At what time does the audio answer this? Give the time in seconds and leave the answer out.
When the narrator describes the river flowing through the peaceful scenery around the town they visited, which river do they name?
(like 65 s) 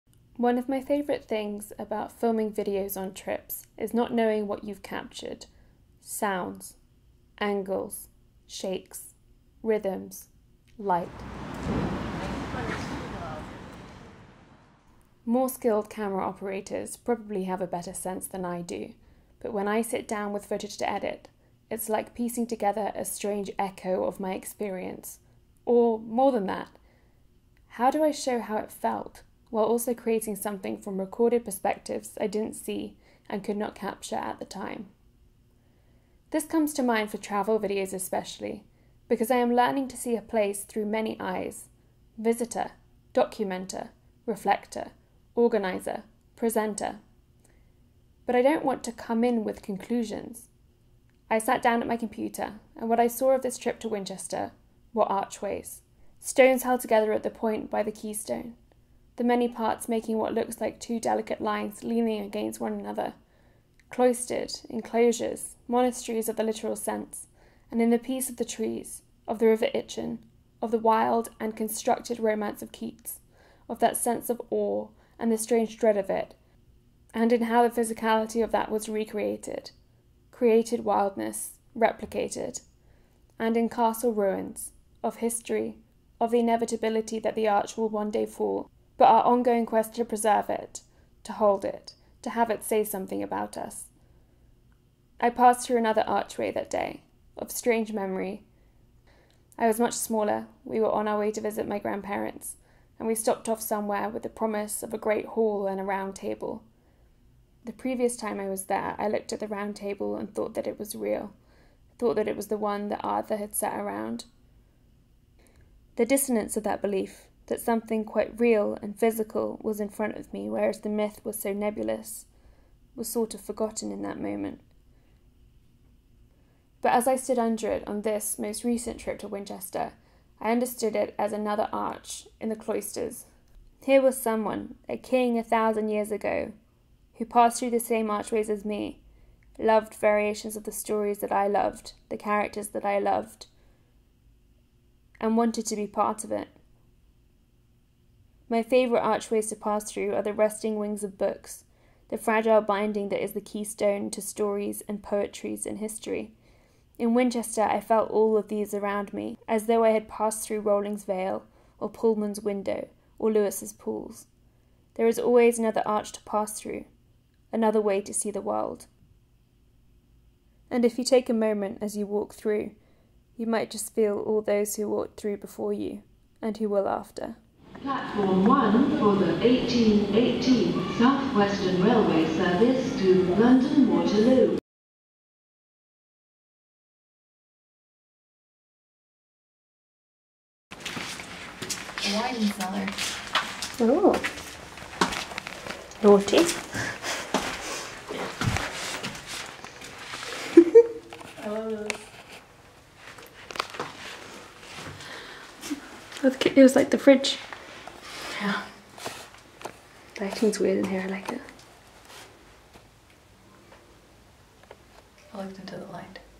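69 s.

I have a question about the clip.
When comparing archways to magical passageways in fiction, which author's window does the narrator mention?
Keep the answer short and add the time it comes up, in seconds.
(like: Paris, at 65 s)
Pullman, at 161 s.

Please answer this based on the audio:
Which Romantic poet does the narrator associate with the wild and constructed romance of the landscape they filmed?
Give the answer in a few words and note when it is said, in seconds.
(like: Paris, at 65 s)
Keats, at 72 s.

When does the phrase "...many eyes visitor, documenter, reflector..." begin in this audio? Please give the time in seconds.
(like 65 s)
40 s.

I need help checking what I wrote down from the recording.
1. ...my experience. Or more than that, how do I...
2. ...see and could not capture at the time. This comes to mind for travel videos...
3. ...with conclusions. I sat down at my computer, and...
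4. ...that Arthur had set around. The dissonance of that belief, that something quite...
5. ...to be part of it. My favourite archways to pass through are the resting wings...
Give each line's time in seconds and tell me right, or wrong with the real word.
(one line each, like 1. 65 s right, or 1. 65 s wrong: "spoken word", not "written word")
1. 24 s right
2. 32 s right
3. 49 s right
4. 112 s right
5. 145 s right.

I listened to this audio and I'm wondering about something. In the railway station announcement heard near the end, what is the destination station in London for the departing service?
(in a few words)
London Waterloo.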